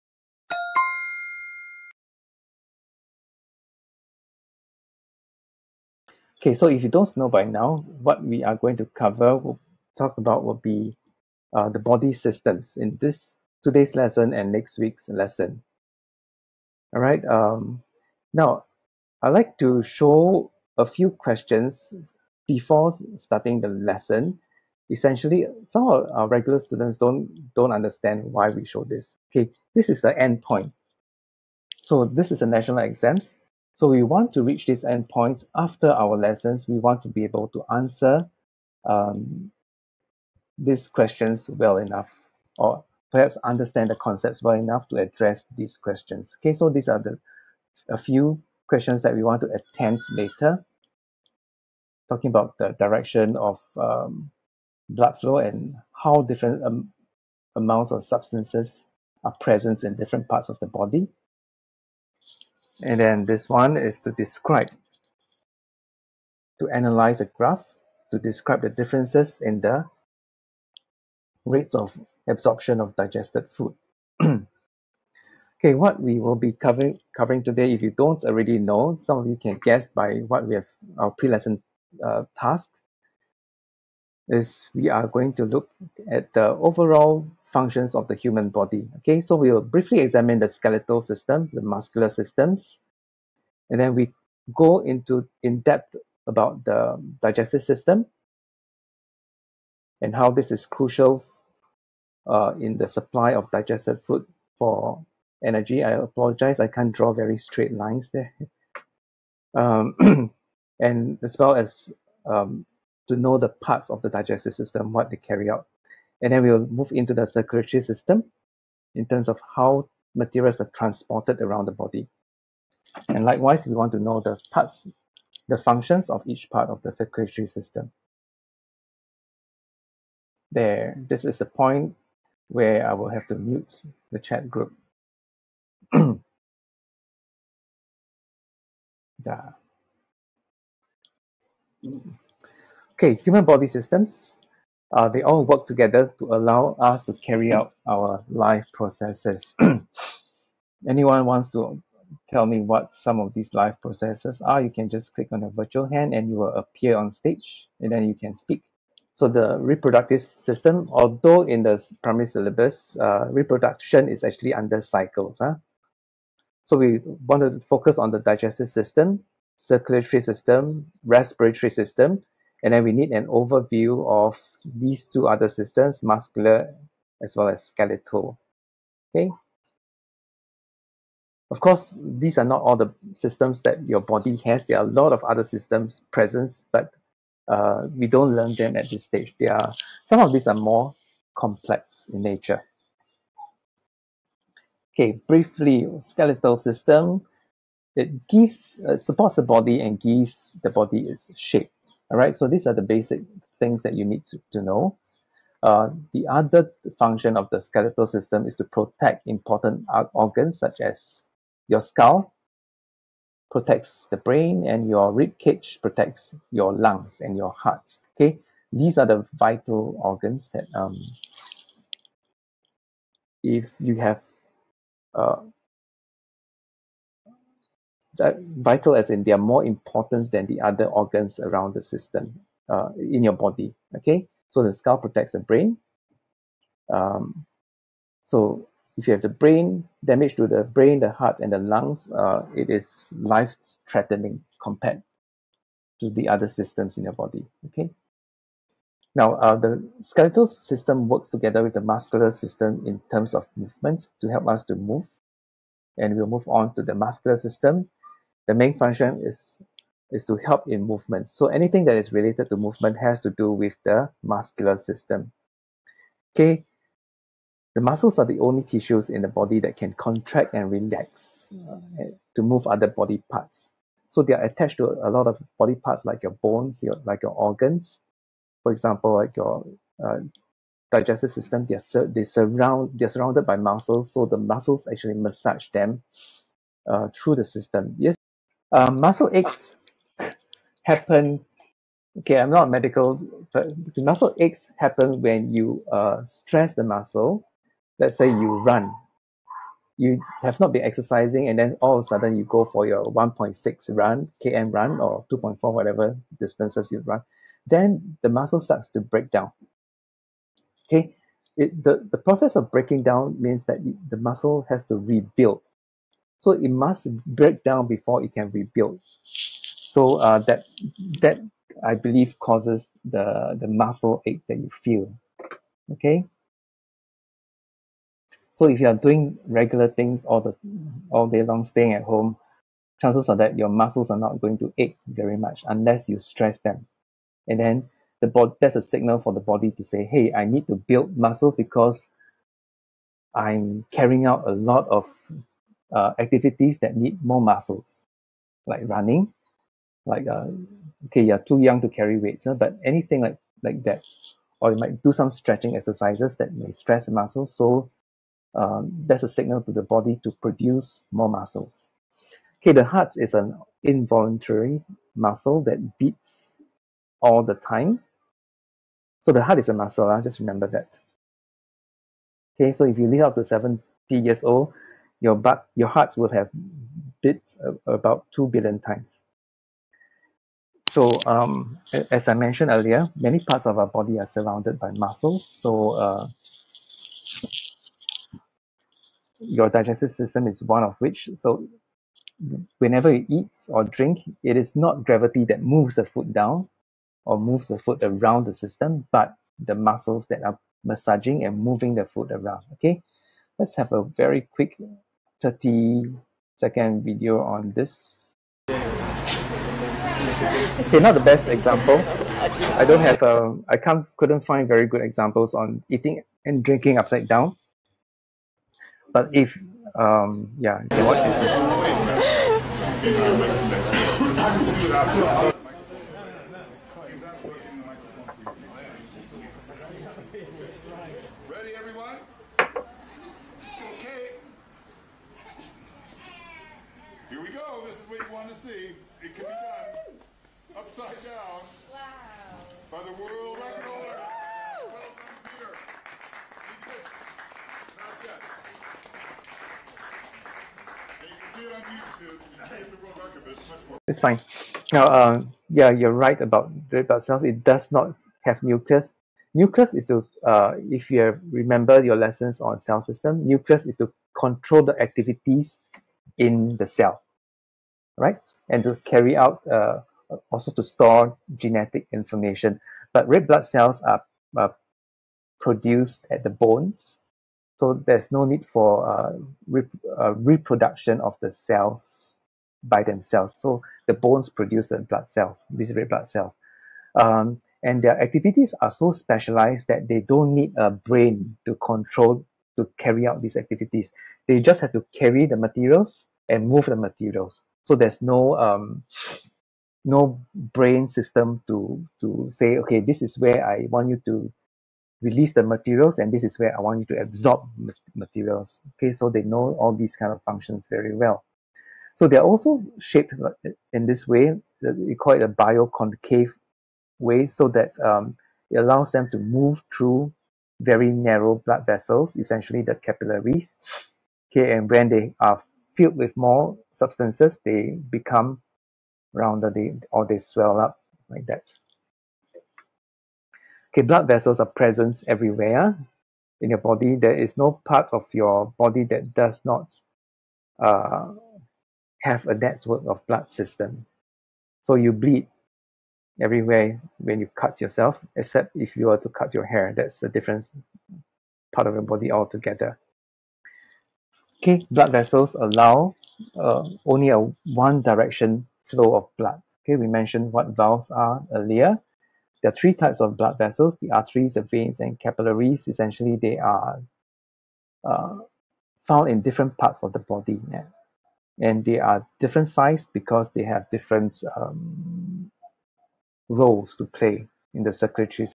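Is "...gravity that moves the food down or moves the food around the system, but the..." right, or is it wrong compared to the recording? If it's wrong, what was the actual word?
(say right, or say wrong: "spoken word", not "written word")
right.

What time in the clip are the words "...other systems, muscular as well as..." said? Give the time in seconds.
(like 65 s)
175 s.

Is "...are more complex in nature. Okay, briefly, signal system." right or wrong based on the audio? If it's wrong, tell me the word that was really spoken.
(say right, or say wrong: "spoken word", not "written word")
wrong: "skeletal", not "signal".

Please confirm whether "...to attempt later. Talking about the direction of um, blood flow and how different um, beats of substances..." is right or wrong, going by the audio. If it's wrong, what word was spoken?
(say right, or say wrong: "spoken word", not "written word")
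wrong: "amounts", not "beats".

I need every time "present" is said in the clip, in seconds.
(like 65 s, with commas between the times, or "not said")
59 s, 186 s, 534 s.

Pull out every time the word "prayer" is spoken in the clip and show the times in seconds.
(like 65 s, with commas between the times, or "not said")
not said.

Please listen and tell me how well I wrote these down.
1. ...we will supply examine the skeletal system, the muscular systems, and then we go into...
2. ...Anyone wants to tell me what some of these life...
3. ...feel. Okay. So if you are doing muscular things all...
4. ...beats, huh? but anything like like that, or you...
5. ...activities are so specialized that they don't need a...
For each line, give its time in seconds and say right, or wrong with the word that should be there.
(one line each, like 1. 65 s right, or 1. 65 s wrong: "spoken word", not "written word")
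1. 89 s wrong: "briefly", not "supply"
2. 150 s right
3. 324 s wrong: "regular", not "muscular"
4. 352 s wrong: "weights", not "beats"
5. 488 s right.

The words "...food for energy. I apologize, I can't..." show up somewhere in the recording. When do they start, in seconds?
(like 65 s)
104 s.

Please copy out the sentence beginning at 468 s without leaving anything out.
And to carry out, uh, also to store genetic information.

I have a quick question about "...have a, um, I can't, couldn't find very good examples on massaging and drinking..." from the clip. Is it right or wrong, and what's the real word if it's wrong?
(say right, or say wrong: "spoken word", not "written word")
wrong: "eating", not "massaging".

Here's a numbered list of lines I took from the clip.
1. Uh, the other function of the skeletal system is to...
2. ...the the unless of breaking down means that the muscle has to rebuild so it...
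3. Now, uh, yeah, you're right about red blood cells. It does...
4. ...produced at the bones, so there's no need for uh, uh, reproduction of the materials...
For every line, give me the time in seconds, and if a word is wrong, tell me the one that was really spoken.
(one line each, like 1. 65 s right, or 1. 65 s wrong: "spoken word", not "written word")
1. 205 s right
2. 311 s wrong: "process", not "unless"
3. 454 s right
4. 475 s wrong: "cells", not "materials".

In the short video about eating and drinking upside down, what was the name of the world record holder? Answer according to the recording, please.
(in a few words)
Peter.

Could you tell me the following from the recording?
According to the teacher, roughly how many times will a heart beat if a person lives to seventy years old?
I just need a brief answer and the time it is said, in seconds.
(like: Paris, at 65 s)
about 2 billion, at 377 s.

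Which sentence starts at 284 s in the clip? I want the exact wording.
So the muscles actually massage them uh, through the system.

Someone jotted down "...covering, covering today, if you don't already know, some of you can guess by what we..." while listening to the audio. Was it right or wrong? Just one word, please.
right.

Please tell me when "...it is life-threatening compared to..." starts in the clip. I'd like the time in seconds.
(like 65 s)
242 s.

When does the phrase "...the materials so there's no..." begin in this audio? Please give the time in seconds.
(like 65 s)
496 s.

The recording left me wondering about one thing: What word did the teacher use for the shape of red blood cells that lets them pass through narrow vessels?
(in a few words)
bioconcave.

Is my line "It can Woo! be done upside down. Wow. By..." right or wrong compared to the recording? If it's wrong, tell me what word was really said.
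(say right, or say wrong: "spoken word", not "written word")
right.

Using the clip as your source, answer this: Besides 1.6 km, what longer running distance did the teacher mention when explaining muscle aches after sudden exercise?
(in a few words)
2.4.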